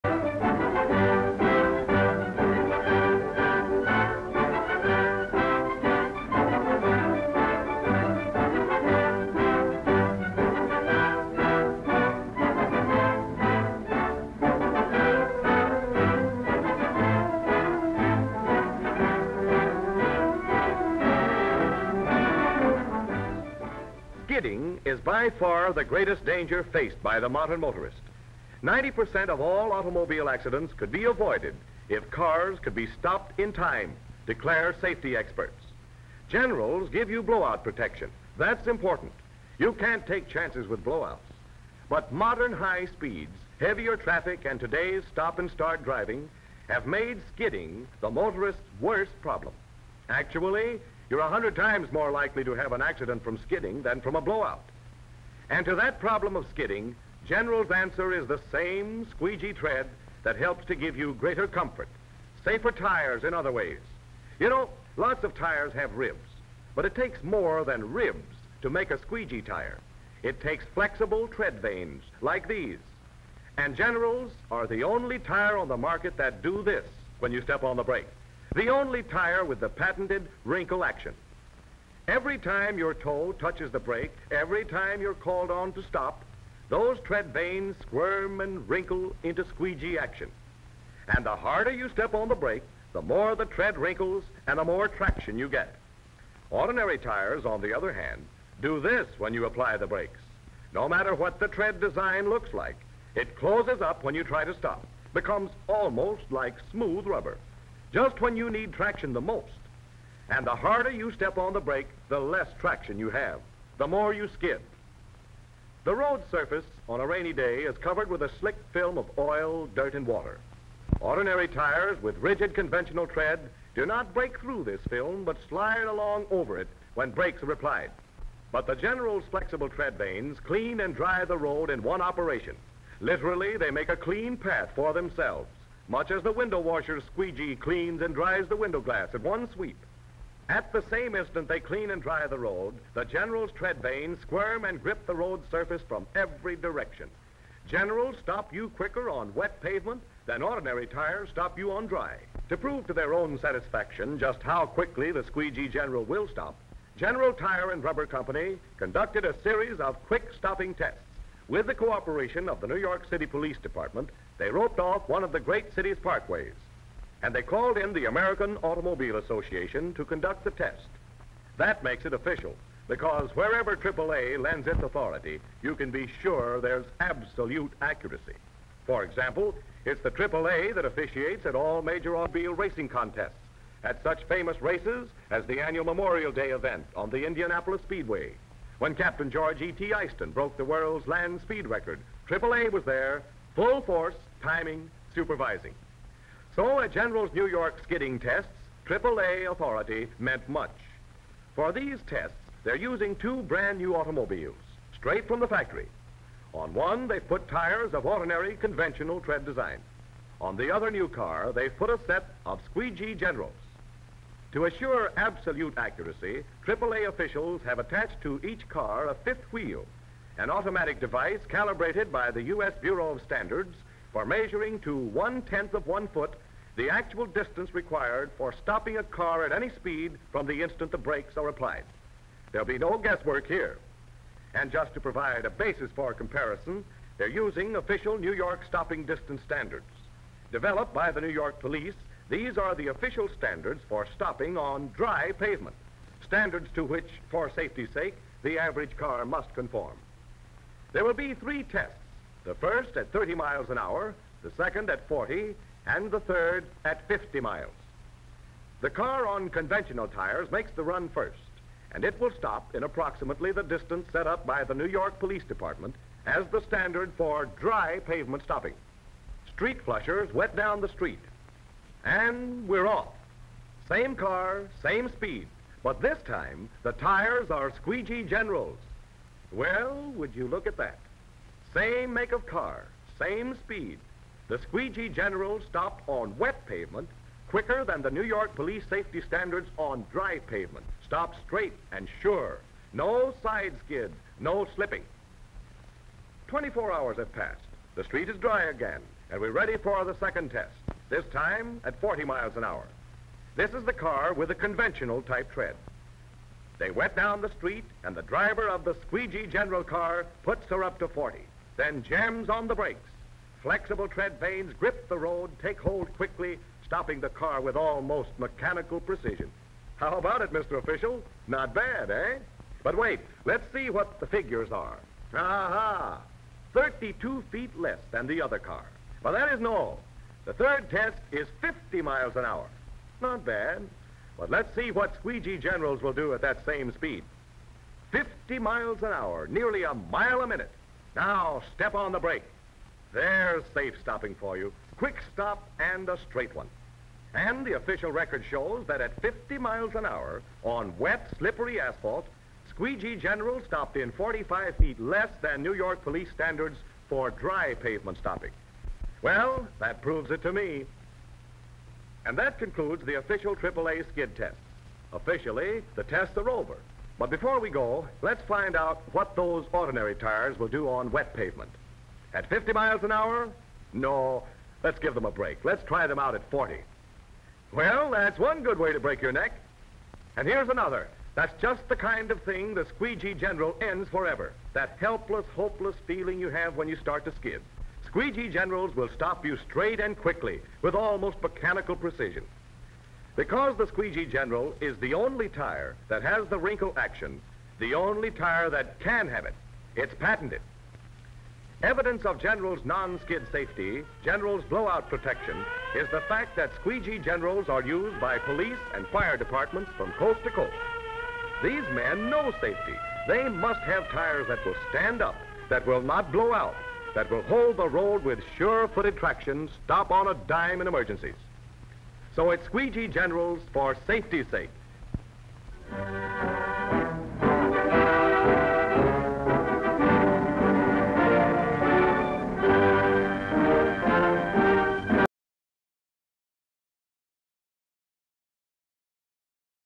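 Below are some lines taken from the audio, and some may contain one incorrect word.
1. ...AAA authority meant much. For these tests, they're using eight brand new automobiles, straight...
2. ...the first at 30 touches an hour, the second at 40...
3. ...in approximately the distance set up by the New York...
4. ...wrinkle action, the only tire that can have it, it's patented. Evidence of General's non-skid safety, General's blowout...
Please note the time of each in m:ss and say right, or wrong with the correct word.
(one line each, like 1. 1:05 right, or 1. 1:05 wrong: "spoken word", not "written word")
1. 3:18 wrong: "two", not "eight"
2. 4:12 wrong: "miles", not "touches"
3. 4:22 right
4. 6:36 right.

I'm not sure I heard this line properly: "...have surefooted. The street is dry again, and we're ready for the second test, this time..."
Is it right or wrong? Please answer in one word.
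wrong.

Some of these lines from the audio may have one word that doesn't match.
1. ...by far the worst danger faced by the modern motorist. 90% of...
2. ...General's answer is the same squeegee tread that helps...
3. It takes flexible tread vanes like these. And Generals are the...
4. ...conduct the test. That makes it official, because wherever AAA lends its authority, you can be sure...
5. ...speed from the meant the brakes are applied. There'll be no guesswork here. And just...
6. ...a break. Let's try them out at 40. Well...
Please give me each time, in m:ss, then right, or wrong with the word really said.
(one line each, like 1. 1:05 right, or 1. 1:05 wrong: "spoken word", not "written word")
1. 0:24 wrong: "greatest", not "worst"
2. 0:57 right
3. 1:10 right
4. 2:50 right
5. 3:49 wrong: "instant", not "meant"
6. 6:15 right.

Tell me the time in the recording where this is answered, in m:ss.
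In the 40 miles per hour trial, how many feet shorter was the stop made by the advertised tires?
5:26.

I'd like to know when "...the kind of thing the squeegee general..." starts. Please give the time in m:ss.
6:21.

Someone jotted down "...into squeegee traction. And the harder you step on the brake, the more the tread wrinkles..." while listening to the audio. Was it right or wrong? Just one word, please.
wrong.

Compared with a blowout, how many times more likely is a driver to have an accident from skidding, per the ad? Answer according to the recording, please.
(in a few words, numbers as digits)
a hundred times.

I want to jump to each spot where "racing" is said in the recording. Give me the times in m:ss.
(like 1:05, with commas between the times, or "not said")
3:02.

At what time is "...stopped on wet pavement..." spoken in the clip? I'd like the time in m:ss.
4:45.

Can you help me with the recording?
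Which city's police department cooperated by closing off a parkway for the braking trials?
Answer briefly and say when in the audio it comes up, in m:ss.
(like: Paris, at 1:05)
New York City, at 2:42.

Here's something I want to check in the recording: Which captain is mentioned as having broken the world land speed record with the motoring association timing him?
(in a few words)
George E.T. Eyston.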